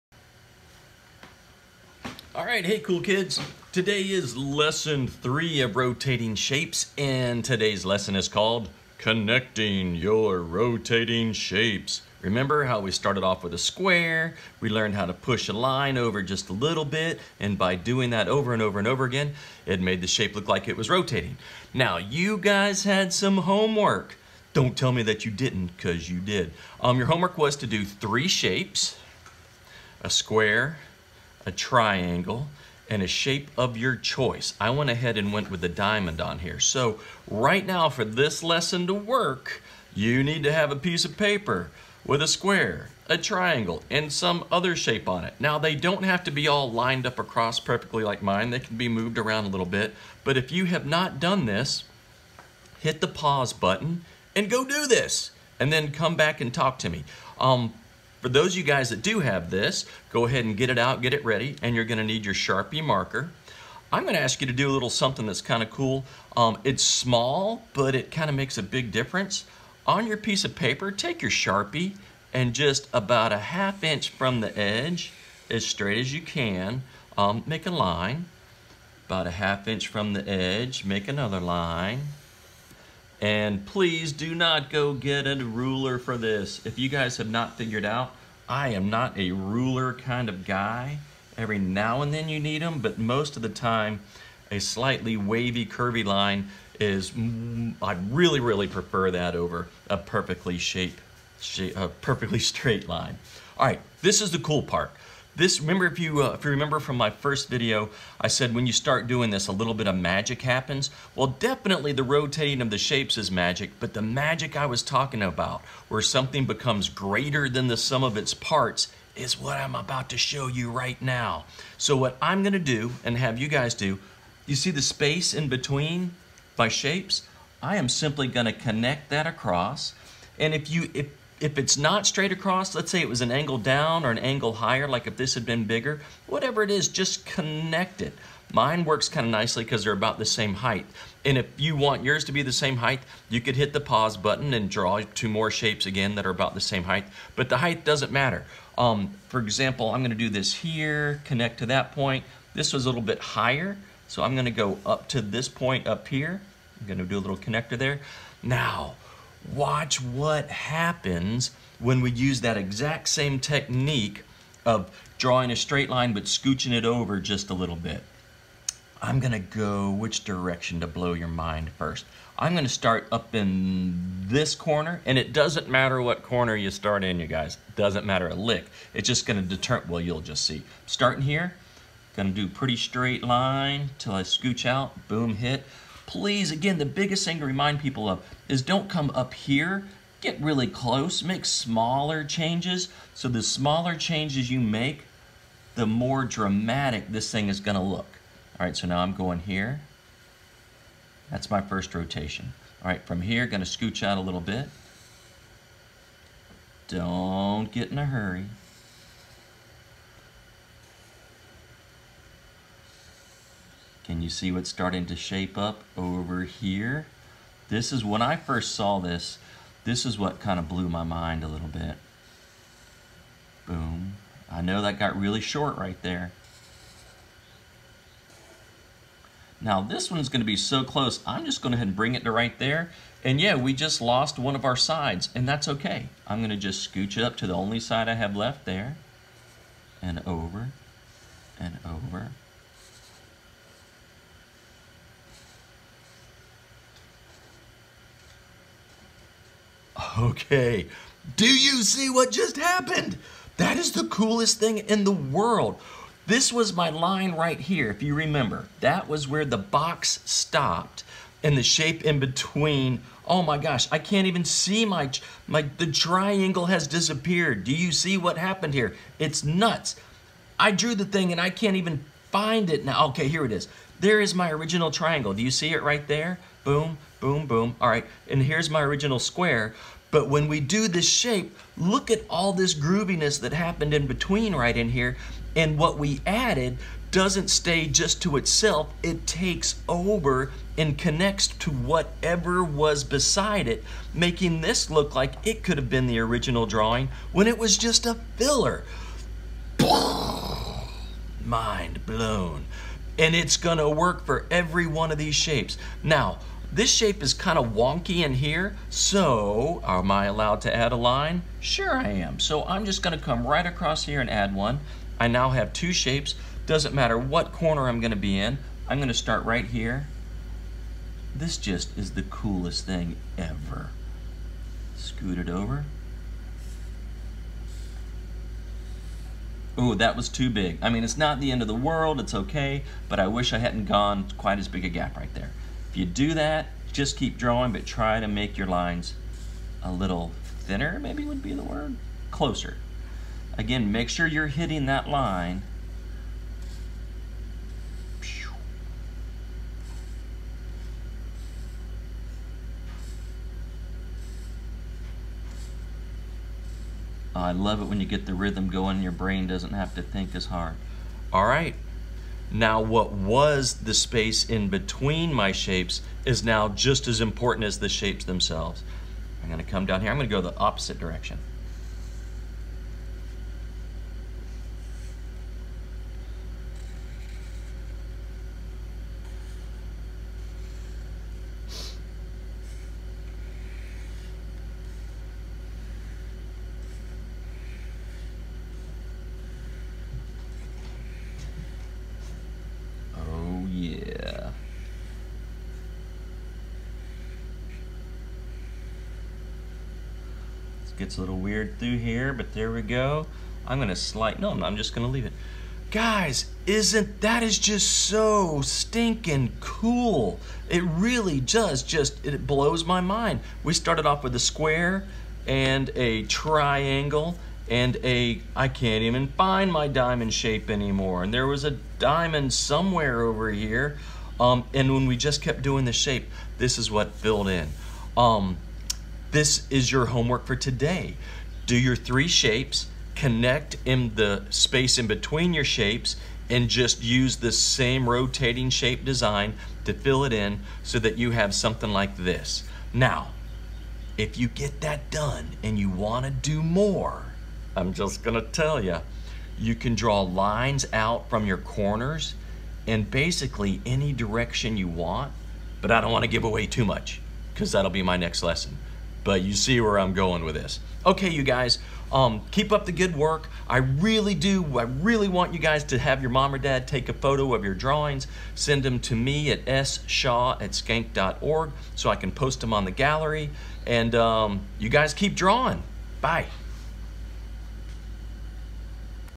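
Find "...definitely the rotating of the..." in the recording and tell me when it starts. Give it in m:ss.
1:51.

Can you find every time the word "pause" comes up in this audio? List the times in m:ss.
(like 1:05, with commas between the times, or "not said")
0:53, 2:23.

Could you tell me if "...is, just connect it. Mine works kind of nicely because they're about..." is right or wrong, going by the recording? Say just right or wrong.
right.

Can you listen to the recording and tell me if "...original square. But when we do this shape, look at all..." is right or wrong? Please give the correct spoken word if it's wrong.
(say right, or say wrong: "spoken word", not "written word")
right.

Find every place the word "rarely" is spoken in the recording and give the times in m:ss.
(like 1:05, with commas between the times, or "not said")
not said.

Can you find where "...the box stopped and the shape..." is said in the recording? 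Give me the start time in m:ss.
4:19.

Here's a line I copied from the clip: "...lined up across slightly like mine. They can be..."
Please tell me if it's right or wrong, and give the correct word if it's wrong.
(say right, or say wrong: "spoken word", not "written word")
wrong: "perfectly", not "slightly".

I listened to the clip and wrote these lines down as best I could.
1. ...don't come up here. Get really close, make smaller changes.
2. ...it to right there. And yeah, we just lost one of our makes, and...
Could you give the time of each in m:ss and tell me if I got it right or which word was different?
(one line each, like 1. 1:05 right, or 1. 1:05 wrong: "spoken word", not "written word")
1. 3:08 right
2. 3:52 wrong: "sides", not "makes".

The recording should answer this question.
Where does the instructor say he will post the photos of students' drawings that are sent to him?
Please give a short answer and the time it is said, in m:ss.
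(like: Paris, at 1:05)
the gallery, at 7:52.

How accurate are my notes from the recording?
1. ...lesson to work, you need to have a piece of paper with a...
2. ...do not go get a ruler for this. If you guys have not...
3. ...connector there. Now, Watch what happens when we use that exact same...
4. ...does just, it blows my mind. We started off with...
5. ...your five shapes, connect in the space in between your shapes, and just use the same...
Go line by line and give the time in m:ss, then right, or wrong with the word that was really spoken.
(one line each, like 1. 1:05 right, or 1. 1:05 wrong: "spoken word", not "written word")
1. 0:38 right
2. 1:24 right
3. 2:37 right
4. 6:51 right
5. 7:11 wrong: "three", not "five".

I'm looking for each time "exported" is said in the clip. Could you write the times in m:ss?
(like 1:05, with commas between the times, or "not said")
not said.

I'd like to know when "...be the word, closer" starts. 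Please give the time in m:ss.
5:41.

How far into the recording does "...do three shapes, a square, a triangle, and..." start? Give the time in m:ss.
0:27.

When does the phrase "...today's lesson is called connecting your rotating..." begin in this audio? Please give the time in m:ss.
0:07.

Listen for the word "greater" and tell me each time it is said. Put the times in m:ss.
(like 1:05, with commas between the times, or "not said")
1:56.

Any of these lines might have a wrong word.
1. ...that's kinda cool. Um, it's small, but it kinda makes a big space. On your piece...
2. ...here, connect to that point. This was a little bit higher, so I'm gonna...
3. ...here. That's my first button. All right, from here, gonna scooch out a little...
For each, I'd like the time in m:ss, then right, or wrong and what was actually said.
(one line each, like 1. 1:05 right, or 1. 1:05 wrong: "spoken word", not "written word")
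1. 1:05 wrong: "difference", not "space"
2. 2:30 right
3. 3:19 wrong: "rotation", not "button".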